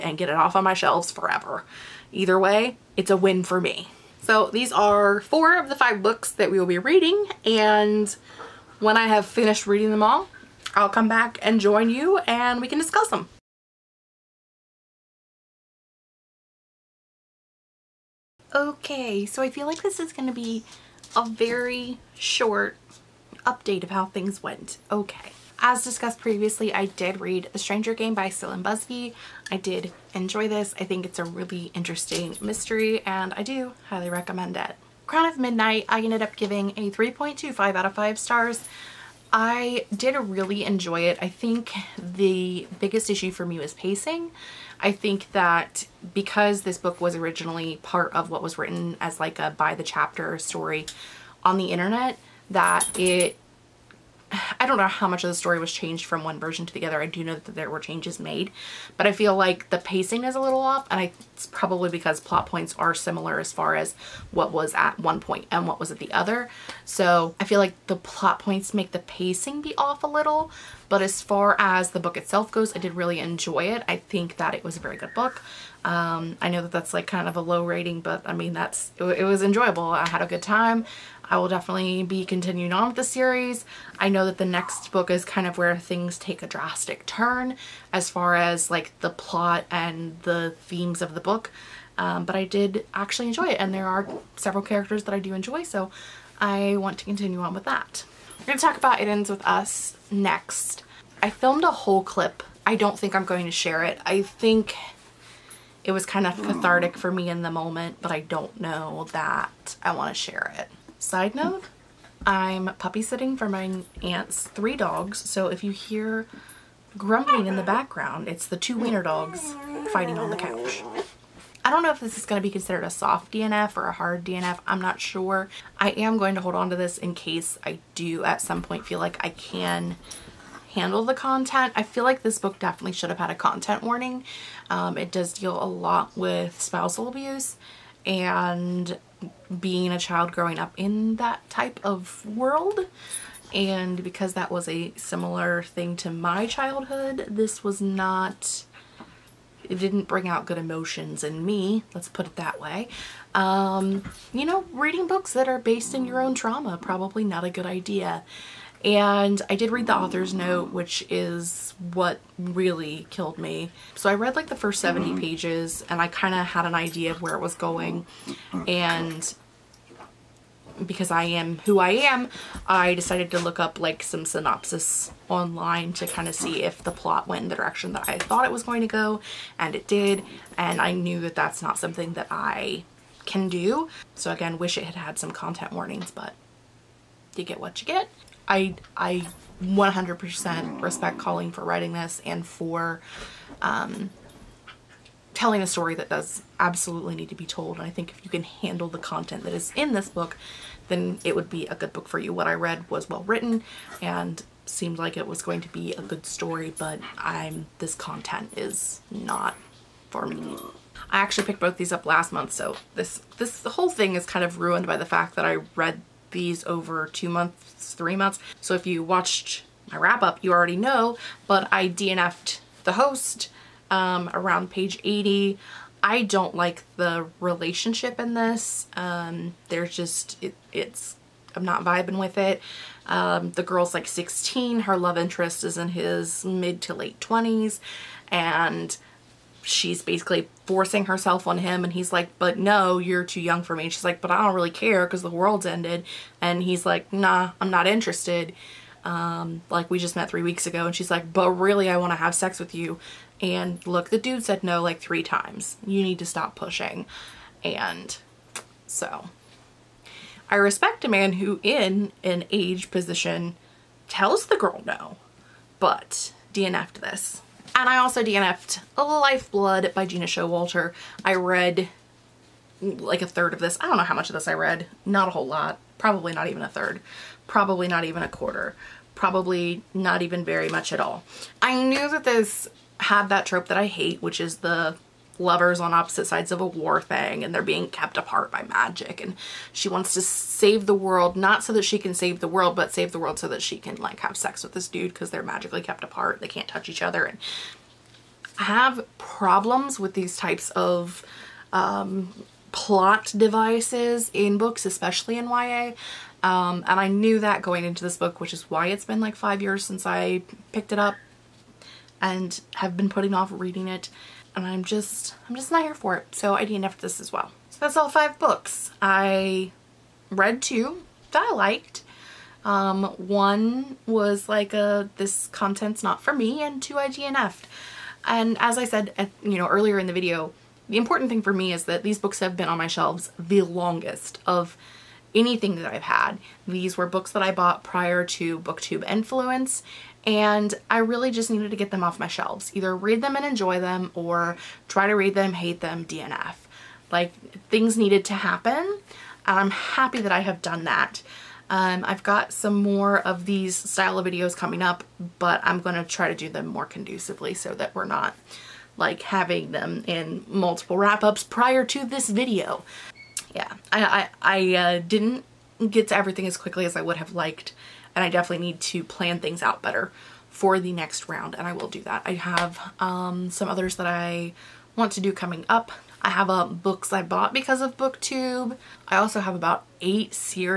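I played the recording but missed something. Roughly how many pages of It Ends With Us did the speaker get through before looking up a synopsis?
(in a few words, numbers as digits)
70.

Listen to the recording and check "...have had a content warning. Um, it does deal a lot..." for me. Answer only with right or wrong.
right.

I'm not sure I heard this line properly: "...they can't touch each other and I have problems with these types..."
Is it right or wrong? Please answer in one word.
right.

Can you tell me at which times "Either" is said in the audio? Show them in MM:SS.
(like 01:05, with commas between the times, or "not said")
00:02, 05:42.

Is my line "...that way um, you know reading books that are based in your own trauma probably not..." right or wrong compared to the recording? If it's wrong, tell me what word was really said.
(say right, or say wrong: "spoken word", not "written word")
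right.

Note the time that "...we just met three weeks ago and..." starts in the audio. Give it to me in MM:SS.
04:09.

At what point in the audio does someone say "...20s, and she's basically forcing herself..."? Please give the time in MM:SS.
03:57.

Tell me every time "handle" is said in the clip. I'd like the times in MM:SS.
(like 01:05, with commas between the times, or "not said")
02:10, 03:18.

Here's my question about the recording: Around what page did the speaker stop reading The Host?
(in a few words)
80.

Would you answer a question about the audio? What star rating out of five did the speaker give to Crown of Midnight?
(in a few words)
3.25.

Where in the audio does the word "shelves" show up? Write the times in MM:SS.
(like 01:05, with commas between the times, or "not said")
00:00, 05:32, 05:42.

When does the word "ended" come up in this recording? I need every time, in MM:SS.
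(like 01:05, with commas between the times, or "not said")
00:36, 04:05.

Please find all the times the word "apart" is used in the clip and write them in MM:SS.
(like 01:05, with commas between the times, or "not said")
04:48, 04:56.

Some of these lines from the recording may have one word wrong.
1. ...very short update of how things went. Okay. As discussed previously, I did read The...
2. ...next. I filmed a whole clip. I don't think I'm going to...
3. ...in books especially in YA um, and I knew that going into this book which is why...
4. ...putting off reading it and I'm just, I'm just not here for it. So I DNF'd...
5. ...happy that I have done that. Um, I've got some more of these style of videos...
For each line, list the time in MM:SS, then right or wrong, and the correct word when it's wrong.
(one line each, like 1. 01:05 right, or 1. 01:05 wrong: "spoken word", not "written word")
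1. 00:21 right
2. 01:40 right
3. 05:04 right
4. 05:13 right
5. 05:49 right.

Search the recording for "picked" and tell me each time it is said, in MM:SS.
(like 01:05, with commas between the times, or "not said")
03:31, 05:10.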